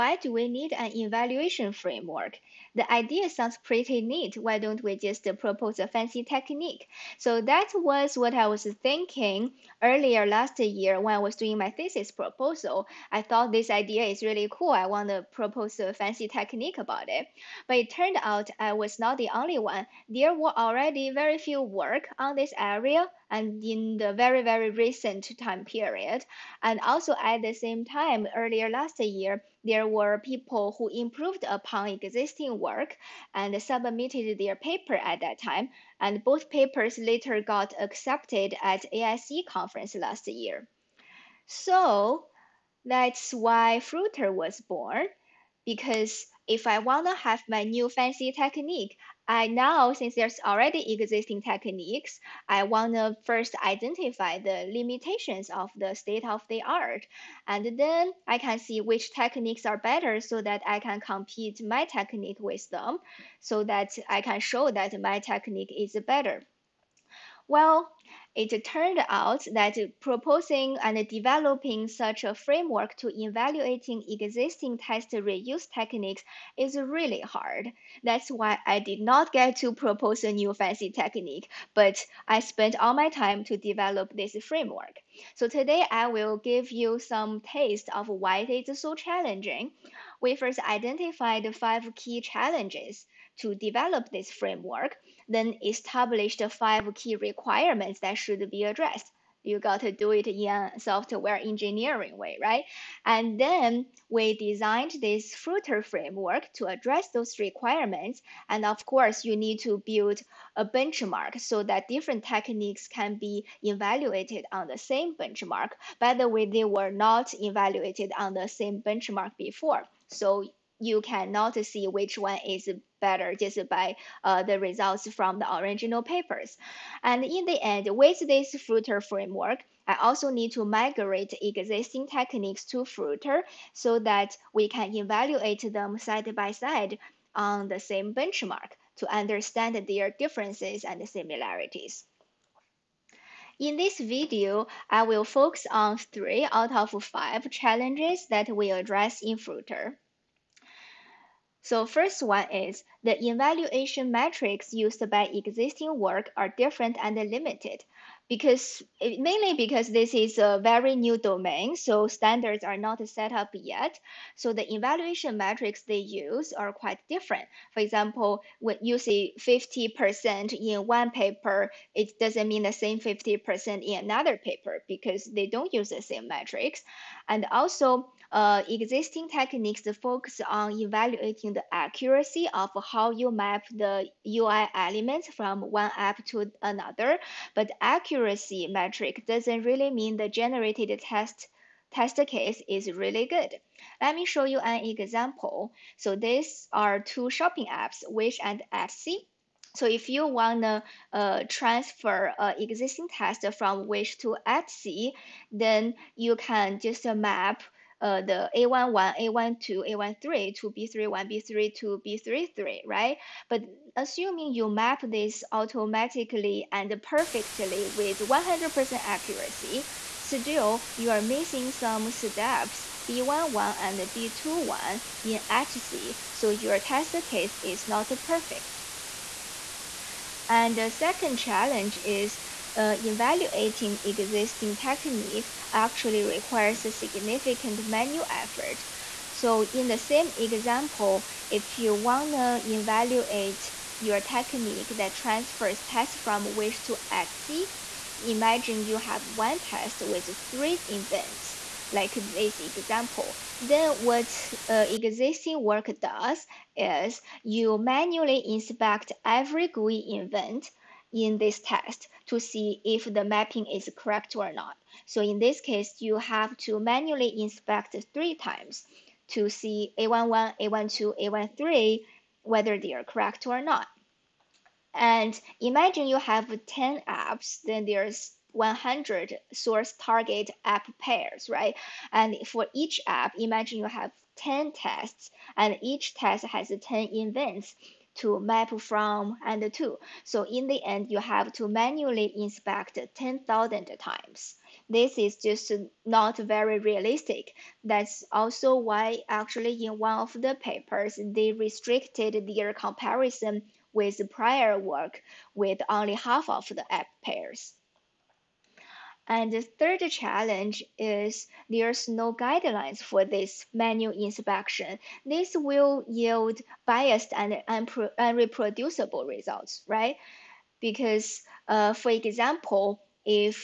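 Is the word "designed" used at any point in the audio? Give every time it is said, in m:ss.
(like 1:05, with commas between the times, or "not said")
1:44.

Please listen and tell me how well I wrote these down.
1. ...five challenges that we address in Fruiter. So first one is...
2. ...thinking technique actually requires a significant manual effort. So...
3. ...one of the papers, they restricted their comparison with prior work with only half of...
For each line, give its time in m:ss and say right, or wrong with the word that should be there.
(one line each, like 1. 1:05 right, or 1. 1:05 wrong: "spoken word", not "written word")
1. 2:27 right
2. 3:54 wrong: "existing", not "thinking"
3. 4:59 right.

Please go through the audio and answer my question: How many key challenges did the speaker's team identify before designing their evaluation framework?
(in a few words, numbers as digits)
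5.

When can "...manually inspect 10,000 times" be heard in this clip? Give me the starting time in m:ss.
4:51.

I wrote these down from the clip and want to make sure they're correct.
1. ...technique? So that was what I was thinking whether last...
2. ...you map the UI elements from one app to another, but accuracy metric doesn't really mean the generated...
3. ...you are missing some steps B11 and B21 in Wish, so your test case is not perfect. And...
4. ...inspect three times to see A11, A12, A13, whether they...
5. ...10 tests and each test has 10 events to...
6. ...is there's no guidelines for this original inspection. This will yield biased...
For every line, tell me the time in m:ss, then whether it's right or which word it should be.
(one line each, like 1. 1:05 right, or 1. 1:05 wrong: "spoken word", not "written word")
1. 0:06 wrong: "earlier", not "whether"
2. 3:03 right
3. 3:40 wrong: "Etsy", not "Wish"
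4. 4:27 right
5. 4:44 right
6. 5:10 wrong: "manual", not "original".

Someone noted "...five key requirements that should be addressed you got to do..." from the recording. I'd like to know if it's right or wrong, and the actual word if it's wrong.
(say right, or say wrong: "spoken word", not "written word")
right.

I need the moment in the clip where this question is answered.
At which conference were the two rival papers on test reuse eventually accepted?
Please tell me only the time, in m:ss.
0:38.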